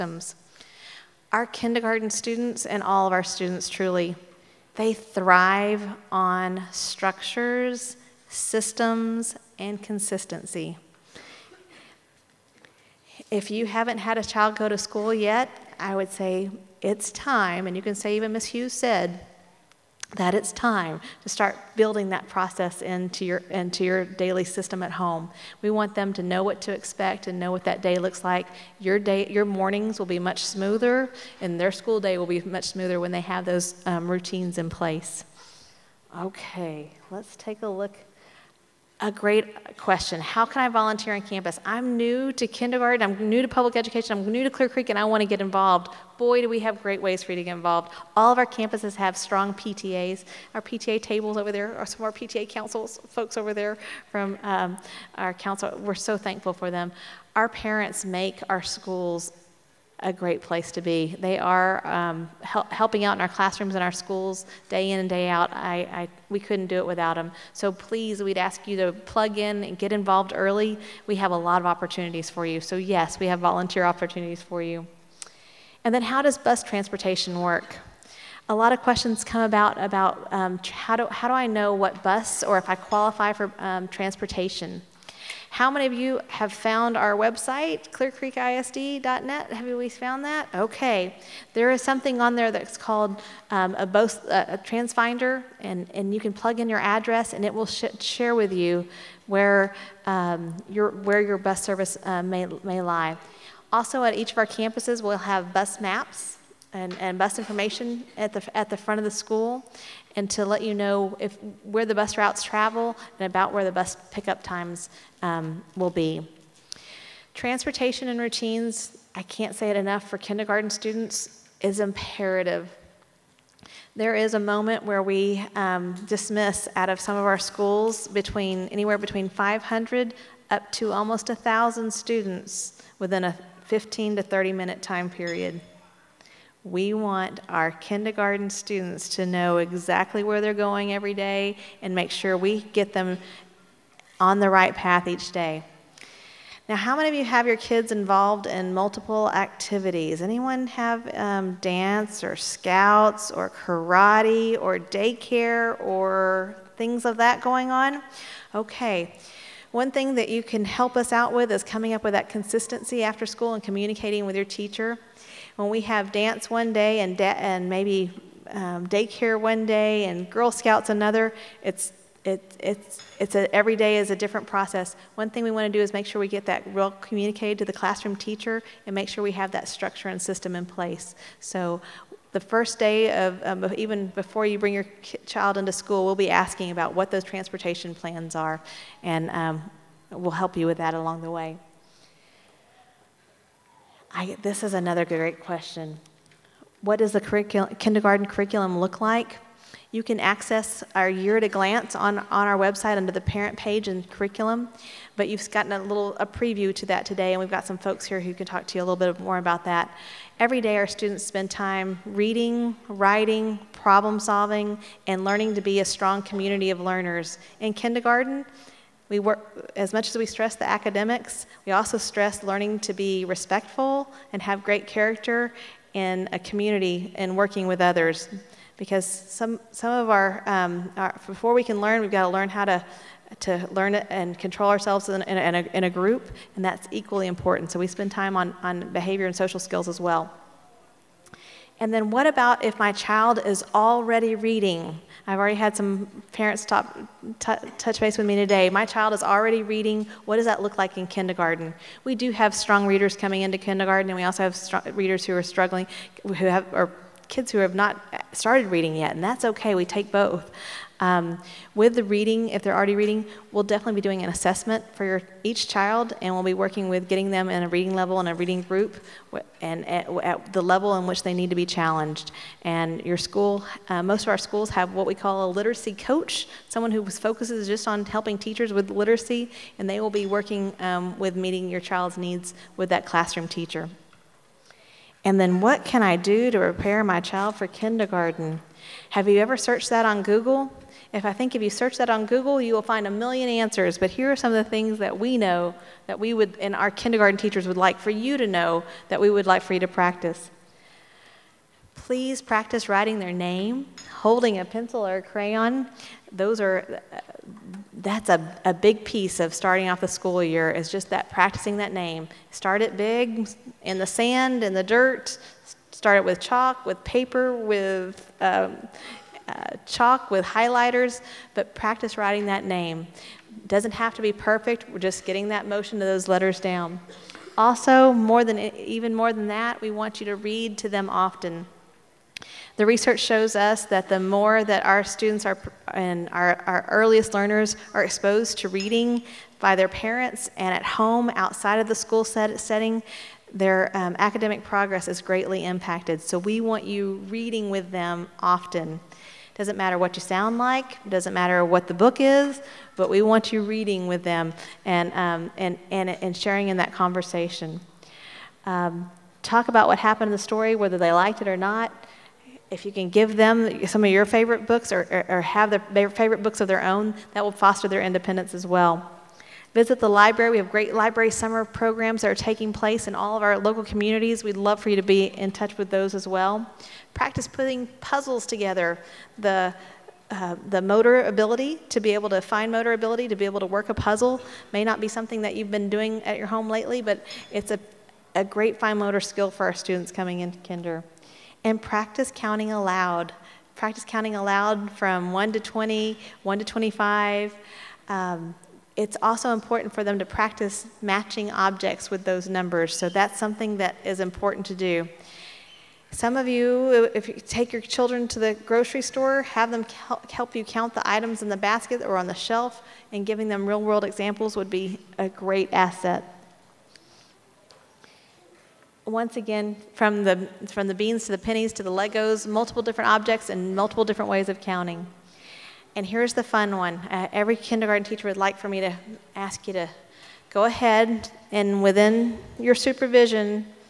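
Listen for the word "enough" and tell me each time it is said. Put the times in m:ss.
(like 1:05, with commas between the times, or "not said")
1:59.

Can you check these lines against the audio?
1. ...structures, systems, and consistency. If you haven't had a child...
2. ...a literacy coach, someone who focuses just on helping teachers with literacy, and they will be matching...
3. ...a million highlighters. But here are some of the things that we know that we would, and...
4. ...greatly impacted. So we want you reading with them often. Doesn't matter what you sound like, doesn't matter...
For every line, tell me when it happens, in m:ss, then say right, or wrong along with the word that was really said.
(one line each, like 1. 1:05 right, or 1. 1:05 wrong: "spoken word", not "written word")
1. 0:06 right
2. 4:35 wrong: "working", not "matching"
3. 4:53 wrong: "answers", not "highlighters"
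4. 5:45 right.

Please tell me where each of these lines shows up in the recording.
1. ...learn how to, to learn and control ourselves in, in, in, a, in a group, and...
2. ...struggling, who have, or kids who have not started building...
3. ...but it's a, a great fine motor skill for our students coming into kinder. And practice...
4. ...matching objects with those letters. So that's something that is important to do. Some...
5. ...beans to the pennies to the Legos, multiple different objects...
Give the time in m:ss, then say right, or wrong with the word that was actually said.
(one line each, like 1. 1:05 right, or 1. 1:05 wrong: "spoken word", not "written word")
1. 3:52 right
2. 4:15 wrong: "reading", not "building"
3. 6:27 right
4. 6:41 wrong: "numbers", not "letters"
5. 7:00 right.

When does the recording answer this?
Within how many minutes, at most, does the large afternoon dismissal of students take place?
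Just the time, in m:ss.
2:14.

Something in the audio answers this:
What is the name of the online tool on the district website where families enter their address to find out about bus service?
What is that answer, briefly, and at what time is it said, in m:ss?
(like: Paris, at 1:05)
transfinder, at 1:34.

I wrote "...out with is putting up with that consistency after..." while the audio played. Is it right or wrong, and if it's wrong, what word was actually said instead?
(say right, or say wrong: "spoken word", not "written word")
wrong: "coming", not "putting".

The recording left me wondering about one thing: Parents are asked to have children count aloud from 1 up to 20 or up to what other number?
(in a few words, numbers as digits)
25.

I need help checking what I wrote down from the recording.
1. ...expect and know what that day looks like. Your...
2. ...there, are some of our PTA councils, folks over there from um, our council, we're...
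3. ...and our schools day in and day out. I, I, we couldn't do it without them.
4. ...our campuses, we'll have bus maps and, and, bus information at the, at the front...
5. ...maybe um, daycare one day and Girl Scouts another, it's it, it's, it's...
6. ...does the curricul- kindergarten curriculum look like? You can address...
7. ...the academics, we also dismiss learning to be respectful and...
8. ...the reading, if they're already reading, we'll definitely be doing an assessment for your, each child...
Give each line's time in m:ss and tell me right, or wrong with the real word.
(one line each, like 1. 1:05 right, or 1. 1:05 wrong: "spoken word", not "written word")
1. 0:26 right
2. 0:51 right
3. 1:03 right
4. 1:44 right
5. 2:47 right
6. 3:16 wrong: "access", not "address"
7. 3:40 wrong: "stress", not "dismiss"
8. 4:21 right.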